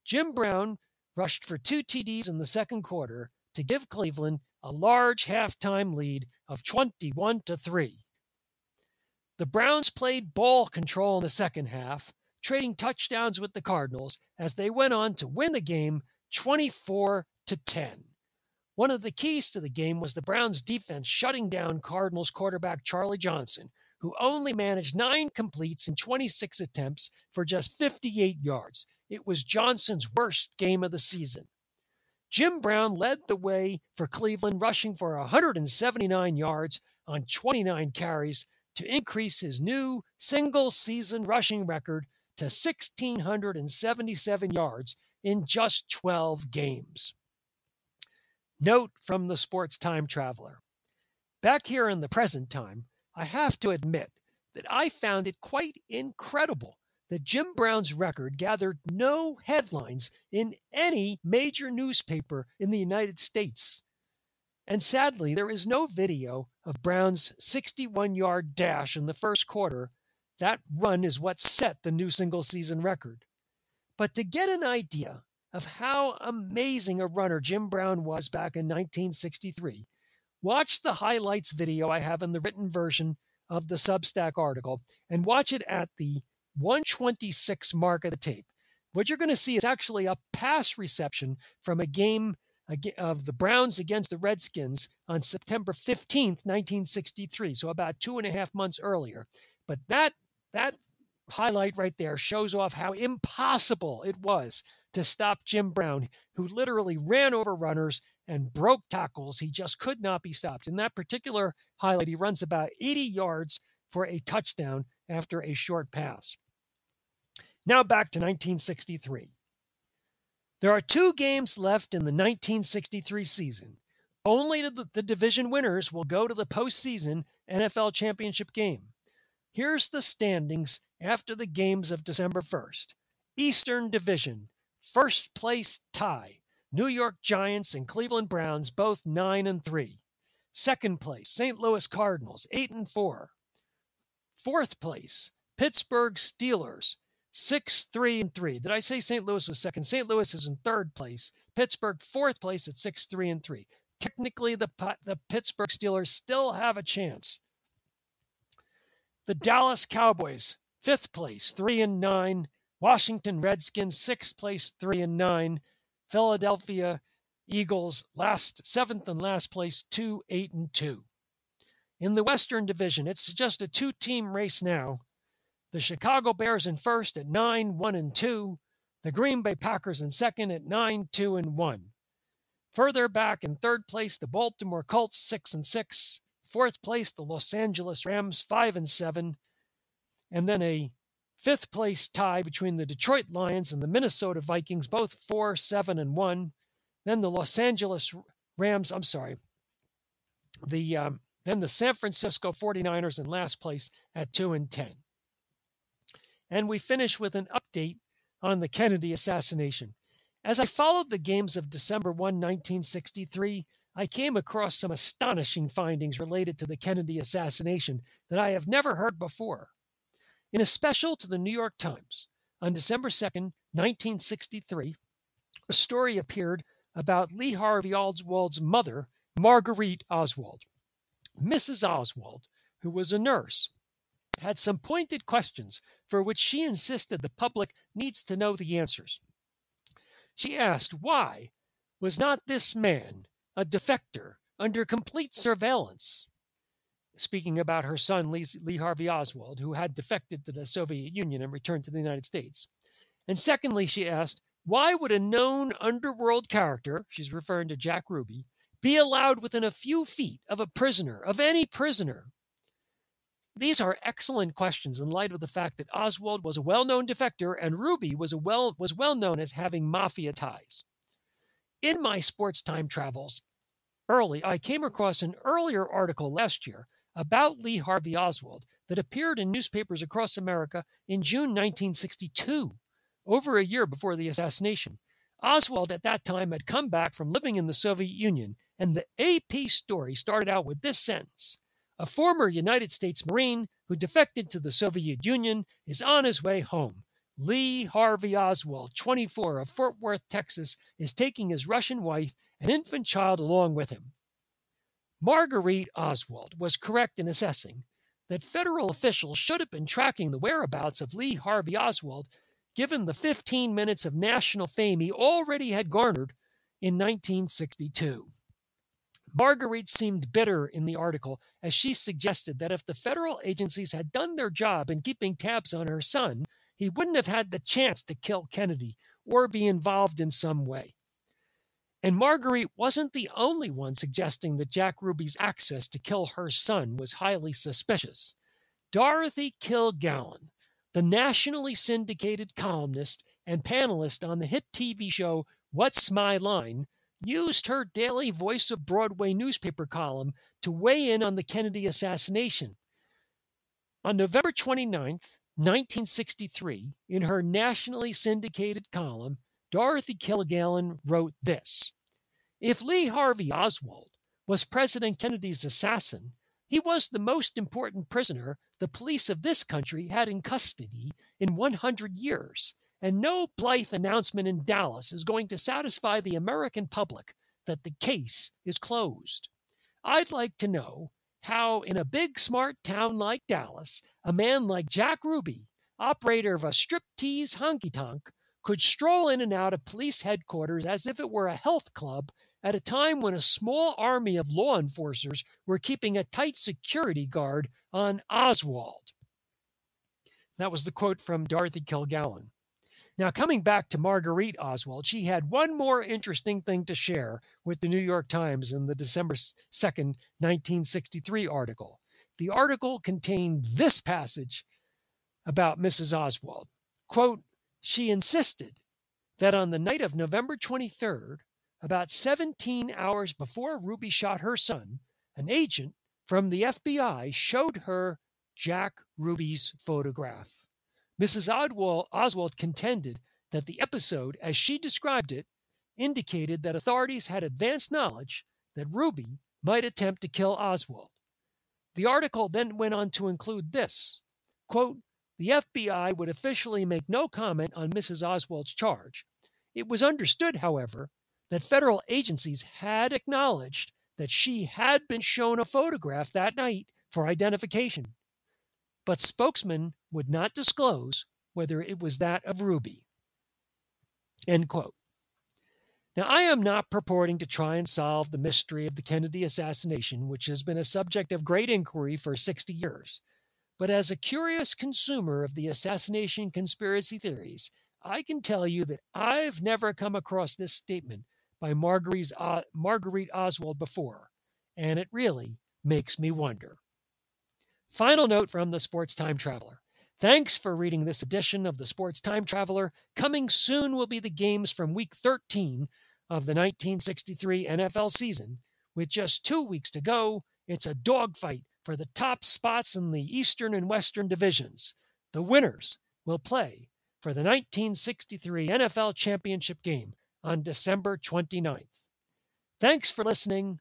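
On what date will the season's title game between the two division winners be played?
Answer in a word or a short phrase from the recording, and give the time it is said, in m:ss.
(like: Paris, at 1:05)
December 29th, at 8:30.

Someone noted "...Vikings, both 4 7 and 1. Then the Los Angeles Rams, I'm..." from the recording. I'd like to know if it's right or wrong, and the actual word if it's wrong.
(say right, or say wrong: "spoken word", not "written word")
right.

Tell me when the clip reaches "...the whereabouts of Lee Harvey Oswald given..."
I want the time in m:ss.
5:10.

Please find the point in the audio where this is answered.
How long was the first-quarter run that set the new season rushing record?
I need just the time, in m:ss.
1:07.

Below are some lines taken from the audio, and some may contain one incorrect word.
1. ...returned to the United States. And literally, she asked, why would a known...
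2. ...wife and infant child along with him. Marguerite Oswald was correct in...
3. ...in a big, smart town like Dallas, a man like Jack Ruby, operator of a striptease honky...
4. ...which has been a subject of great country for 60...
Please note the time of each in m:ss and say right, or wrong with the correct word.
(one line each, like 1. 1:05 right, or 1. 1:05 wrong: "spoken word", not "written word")
1. 4:11 wrong: "secondly", not "literally"
2. 5:02 right
3. 6:21 right
4. 7:50 wrong: "inquiry", not "country".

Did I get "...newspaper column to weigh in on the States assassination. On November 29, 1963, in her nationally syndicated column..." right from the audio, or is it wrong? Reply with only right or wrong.
wrong.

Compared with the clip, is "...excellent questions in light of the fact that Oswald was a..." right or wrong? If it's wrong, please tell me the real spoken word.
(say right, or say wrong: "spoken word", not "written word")
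right.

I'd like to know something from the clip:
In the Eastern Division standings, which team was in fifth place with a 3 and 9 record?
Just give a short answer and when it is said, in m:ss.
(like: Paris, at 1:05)
Dallas Cowboys, at 2:39.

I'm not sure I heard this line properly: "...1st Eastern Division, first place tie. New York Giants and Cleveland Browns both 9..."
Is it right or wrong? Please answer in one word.
right.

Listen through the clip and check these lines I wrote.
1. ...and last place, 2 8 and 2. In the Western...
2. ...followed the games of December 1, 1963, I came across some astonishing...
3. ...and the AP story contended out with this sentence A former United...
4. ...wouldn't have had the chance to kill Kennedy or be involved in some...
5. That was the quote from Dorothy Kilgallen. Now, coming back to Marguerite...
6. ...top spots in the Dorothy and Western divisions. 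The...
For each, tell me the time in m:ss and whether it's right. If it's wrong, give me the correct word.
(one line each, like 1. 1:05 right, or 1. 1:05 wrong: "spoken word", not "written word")
1. 2:49 right
2. 3:30 right
3. 4:48 wrong: "started", not "contended"
4. 5:26 right
5. 6:40 right
6. 8:22 wrong: "Eastern", not "Dorothy".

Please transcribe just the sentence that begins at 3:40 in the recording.
In a special to the New York Times on December 2, 1963, a story appeared about Lee Harvey Oswald's mother, Marguerite Oswald.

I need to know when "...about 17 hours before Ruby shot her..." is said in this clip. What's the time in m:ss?
7:01.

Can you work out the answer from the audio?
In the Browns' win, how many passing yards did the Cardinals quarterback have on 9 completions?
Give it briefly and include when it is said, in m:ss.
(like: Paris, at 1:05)
58, at 0:27.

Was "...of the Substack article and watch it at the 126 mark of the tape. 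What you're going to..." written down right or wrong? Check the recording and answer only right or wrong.
right.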